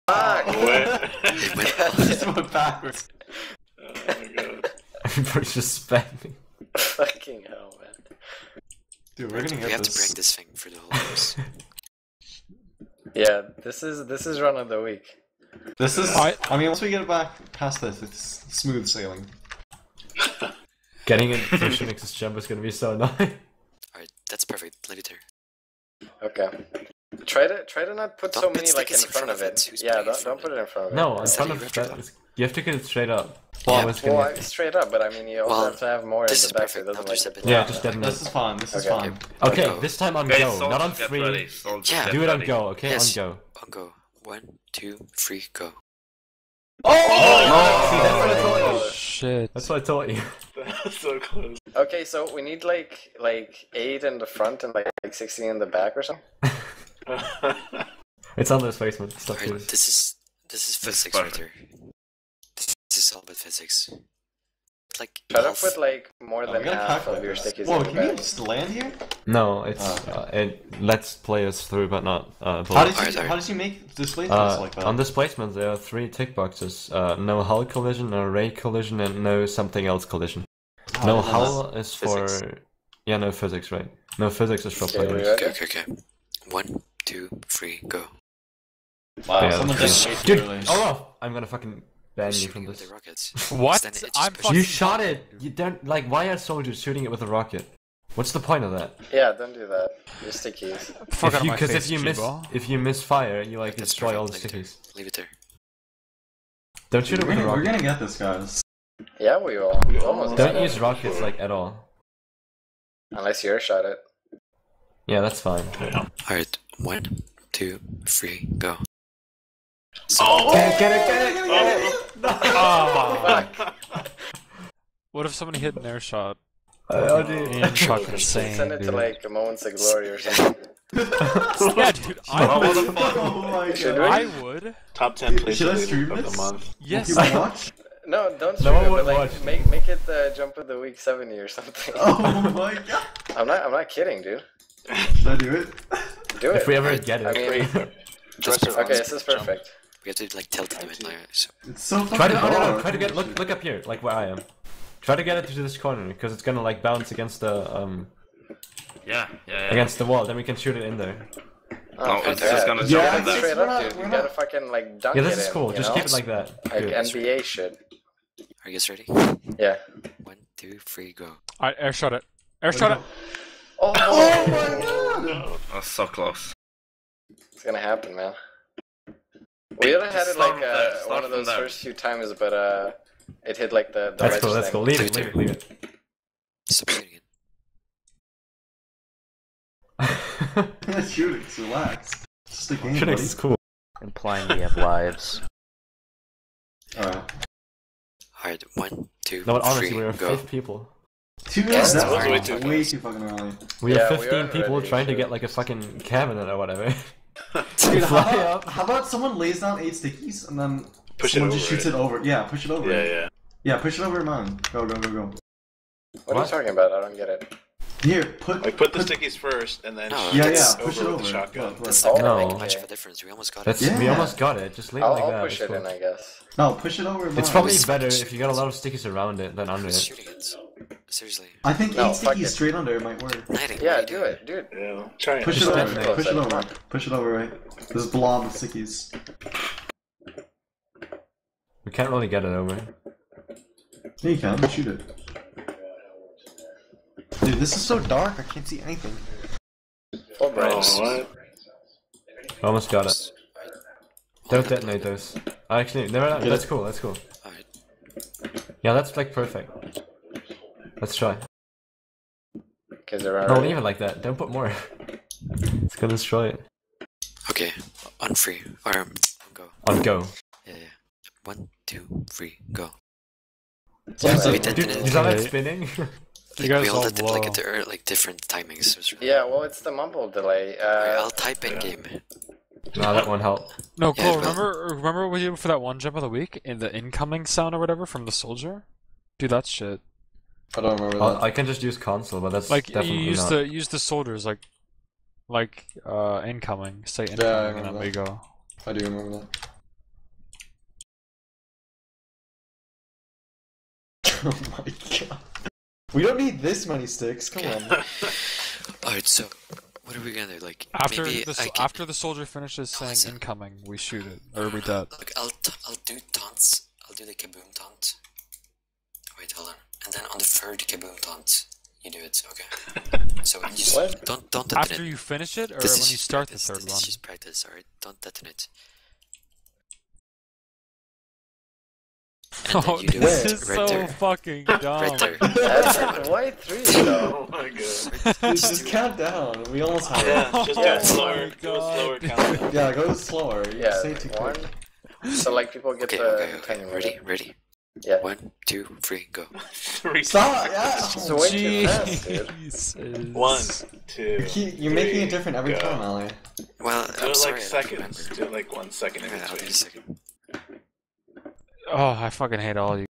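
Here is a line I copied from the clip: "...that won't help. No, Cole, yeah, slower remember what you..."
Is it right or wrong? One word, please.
wrong.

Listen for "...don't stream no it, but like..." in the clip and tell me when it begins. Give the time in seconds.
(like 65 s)
138 s.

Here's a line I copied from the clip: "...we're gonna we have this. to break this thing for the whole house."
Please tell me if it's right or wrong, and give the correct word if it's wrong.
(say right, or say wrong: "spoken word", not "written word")
right.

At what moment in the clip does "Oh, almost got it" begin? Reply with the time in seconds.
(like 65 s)
250 s.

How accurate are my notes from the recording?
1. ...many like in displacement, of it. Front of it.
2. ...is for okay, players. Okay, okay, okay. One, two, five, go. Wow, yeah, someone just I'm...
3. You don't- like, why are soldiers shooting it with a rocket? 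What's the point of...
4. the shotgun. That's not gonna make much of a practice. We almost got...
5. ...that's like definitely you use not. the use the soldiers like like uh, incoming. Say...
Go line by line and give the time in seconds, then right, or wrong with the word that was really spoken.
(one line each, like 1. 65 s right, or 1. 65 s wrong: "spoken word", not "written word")
1. 28 s wrong: "front", not "displacement"
2. 84 s wrong: "three", not "five"
3. 95 s right
4. 221 s wrong: "difference", not "practice"
5. 292 s right.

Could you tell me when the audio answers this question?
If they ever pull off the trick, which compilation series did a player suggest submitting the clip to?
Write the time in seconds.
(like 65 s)
129 s.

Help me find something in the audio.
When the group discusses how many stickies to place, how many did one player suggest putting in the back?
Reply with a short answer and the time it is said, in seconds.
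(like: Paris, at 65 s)
16, at 55 s.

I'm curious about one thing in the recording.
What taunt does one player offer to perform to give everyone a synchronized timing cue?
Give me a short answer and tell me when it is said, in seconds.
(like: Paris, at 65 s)
kaboom taunt, at 317 s.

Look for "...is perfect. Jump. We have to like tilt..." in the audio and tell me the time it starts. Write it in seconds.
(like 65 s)
149 s.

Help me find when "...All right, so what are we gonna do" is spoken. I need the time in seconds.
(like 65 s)
309 s.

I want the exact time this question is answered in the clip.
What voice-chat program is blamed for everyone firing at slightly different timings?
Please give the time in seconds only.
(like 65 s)
279 s.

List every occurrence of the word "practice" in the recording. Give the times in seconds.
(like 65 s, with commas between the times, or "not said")
327 s.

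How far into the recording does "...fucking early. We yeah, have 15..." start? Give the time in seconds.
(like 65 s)
202 s.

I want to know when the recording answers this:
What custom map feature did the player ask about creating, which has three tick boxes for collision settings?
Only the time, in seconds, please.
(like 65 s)
73 s.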